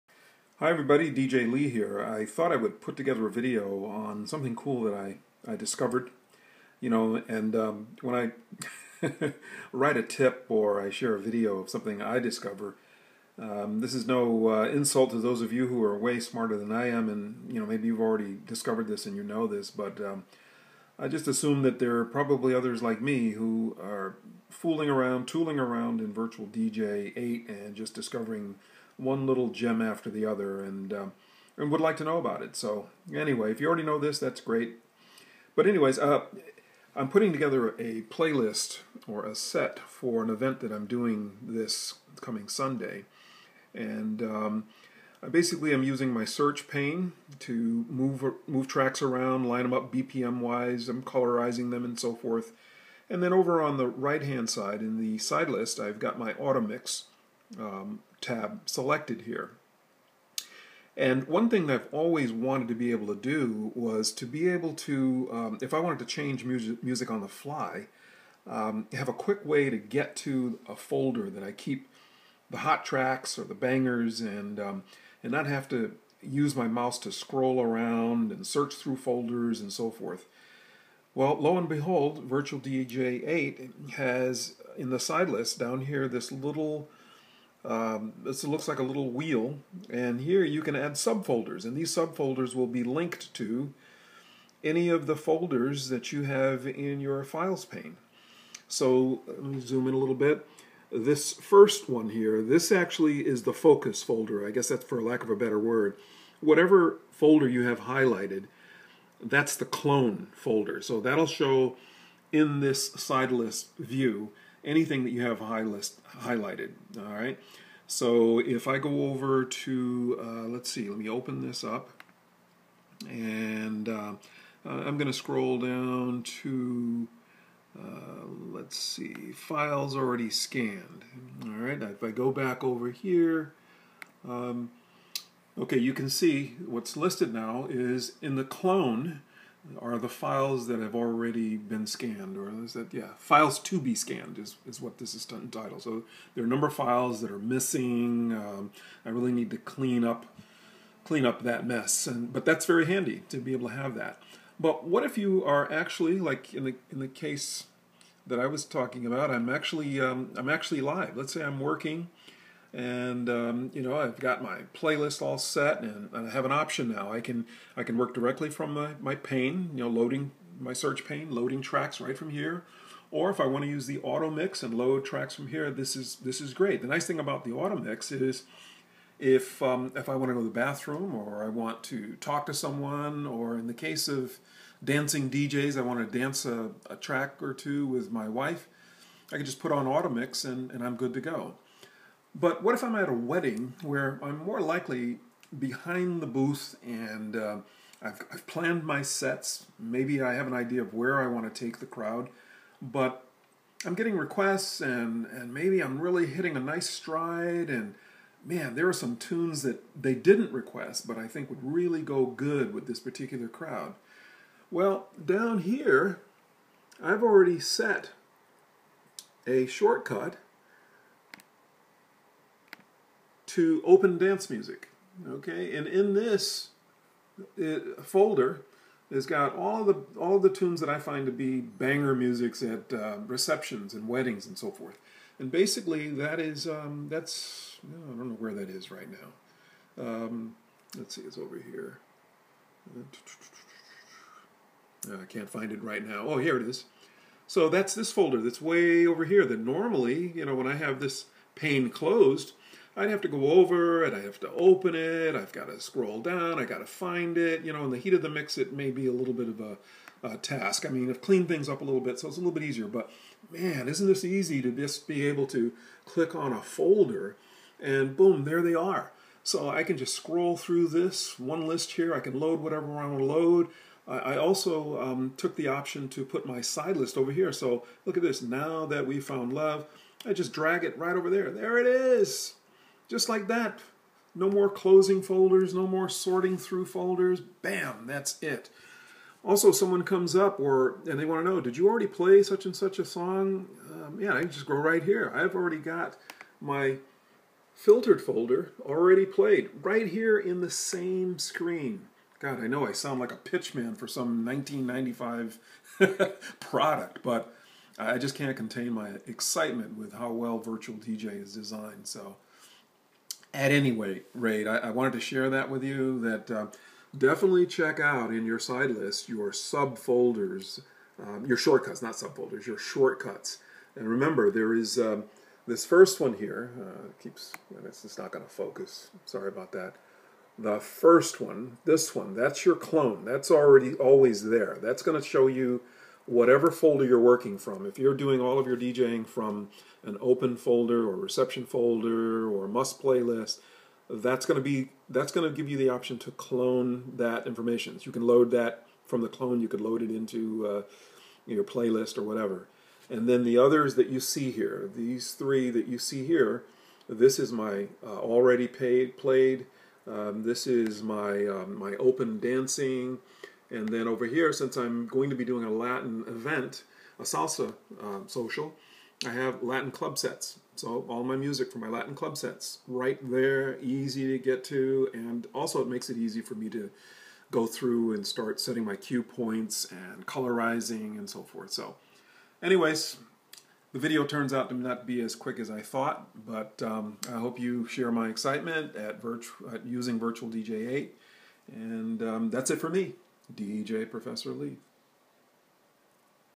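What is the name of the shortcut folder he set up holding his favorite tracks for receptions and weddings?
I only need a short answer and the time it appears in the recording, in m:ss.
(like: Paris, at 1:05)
open dance music, at 3:43.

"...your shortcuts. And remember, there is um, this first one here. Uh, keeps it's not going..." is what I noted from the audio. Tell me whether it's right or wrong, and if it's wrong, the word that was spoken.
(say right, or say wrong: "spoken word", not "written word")
right.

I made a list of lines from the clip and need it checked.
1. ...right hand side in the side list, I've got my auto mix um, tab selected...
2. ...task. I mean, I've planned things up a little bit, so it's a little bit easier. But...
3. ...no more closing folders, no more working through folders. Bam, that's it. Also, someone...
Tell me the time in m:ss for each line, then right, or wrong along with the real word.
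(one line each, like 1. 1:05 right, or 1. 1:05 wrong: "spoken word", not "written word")
1. 0:53 right
2. 4:20 wrong: "cleaned", not "planned"
3. 4:44 wrong: "sorting", not "working".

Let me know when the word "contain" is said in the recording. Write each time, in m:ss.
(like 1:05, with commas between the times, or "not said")
5:08.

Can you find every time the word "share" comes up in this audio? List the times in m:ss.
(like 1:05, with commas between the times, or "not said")
0:10, 5:15, 6:27.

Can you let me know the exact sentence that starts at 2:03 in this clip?
And uh, uh I'm going to scroll down to, uh, let's see, files already scanned.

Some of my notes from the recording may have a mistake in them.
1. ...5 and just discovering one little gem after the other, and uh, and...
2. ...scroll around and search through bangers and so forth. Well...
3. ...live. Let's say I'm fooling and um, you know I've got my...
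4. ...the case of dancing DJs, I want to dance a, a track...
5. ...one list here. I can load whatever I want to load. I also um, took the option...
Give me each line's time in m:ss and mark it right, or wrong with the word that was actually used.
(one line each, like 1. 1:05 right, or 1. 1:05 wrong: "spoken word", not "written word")
1. 0:27 wrong: "8", not "5"
2. 1:17 wrong: "folders", not "bangers"
3. 2:40 wrong: "working", not "fooling"
4. 3:03 right
5. 4:31 right.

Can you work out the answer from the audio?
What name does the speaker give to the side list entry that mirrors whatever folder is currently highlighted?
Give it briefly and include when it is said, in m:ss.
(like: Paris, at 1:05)
clone folder, at 1:49.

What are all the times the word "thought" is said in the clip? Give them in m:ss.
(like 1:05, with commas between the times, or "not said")
0:02, 6:25.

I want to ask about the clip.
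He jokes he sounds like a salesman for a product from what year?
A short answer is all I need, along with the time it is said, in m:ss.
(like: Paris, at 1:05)
1995, at 5:04.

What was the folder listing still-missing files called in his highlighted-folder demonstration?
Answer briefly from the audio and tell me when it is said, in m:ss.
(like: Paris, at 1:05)
files to be scanned, at 2:23.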